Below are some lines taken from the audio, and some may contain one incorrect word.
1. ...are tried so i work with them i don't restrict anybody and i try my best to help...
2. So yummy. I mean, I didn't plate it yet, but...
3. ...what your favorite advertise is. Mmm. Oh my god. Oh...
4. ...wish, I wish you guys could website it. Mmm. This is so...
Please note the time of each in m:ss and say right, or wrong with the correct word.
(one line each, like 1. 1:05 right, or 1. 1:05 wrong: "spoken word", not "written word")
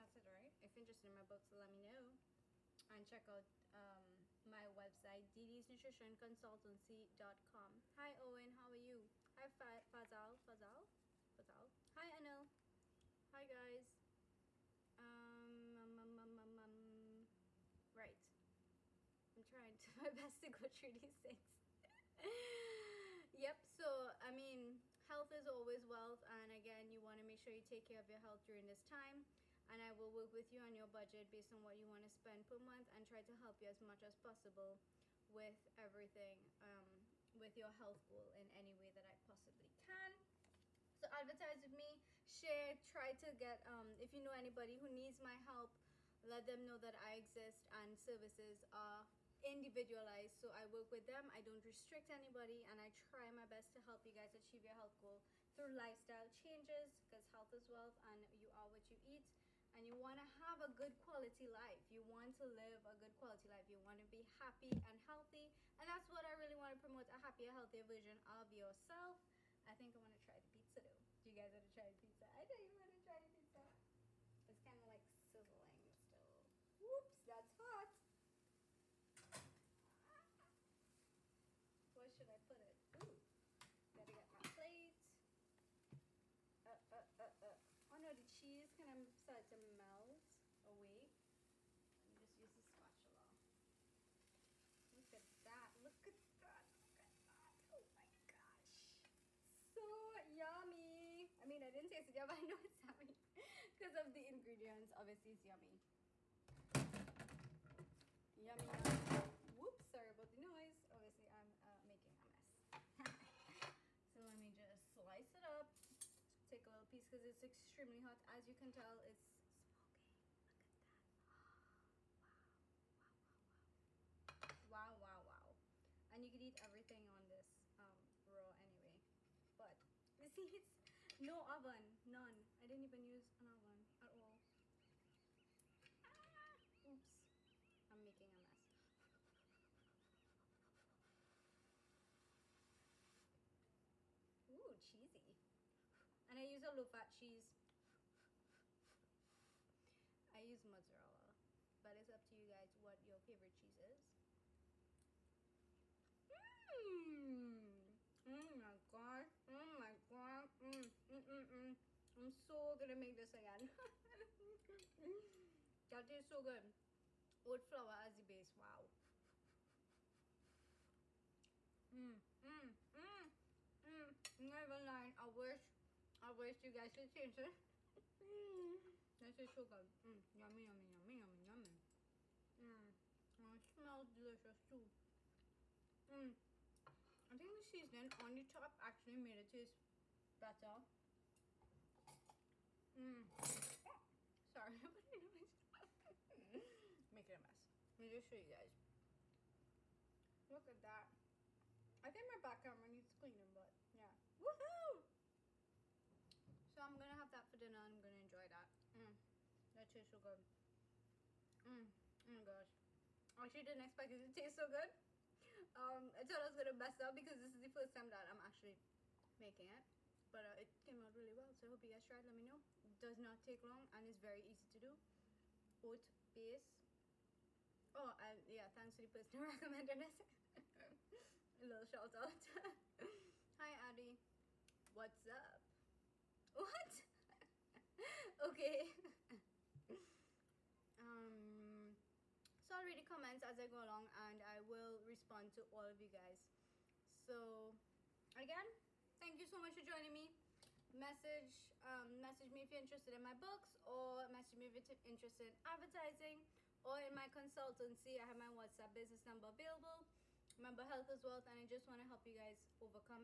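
1. 0:48 wrong: "individualized", not "tried"
2. 1:39 wrong: "taste", not "plate"
3. 2:32 wrong: "cheese", not "advertise"
4. 2:55 wrong: "taste", not "website".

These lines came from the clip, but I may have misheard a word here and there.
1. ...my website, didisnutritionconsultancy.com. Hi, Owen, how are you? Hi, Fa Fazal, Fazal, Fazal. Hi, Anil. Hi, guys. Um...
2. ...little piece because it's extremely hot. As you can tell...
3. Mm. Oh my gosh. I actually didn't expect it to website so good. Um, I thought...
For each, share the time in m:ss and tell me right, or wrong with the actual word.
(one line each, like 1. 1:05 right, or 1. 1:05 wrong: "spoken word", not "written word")
1. 0:04 right
2. 1:56 right
3. 3:31 wrong: "taste", not "website".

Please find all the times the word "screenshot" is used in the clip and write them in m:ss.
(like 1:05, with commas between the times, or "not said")
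not said.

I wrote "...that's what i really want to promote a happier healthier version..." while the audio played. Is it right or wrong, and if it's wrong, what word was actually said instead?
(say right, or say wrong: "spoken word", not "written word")
right.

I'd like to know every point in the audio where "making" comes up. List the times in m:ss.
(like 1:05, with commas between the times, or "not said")
1:51, 2:18, 3:39.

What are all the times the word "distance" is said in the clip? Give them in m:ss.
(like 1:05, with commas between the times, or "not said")
not said.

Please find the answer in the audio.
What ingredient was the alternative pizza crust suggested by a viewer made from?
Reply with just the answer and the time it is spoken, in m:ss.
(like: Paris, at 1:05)
Oat, at 3:45.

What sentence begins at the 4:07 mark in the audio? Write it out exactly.
So, again, thank you so much for joining me.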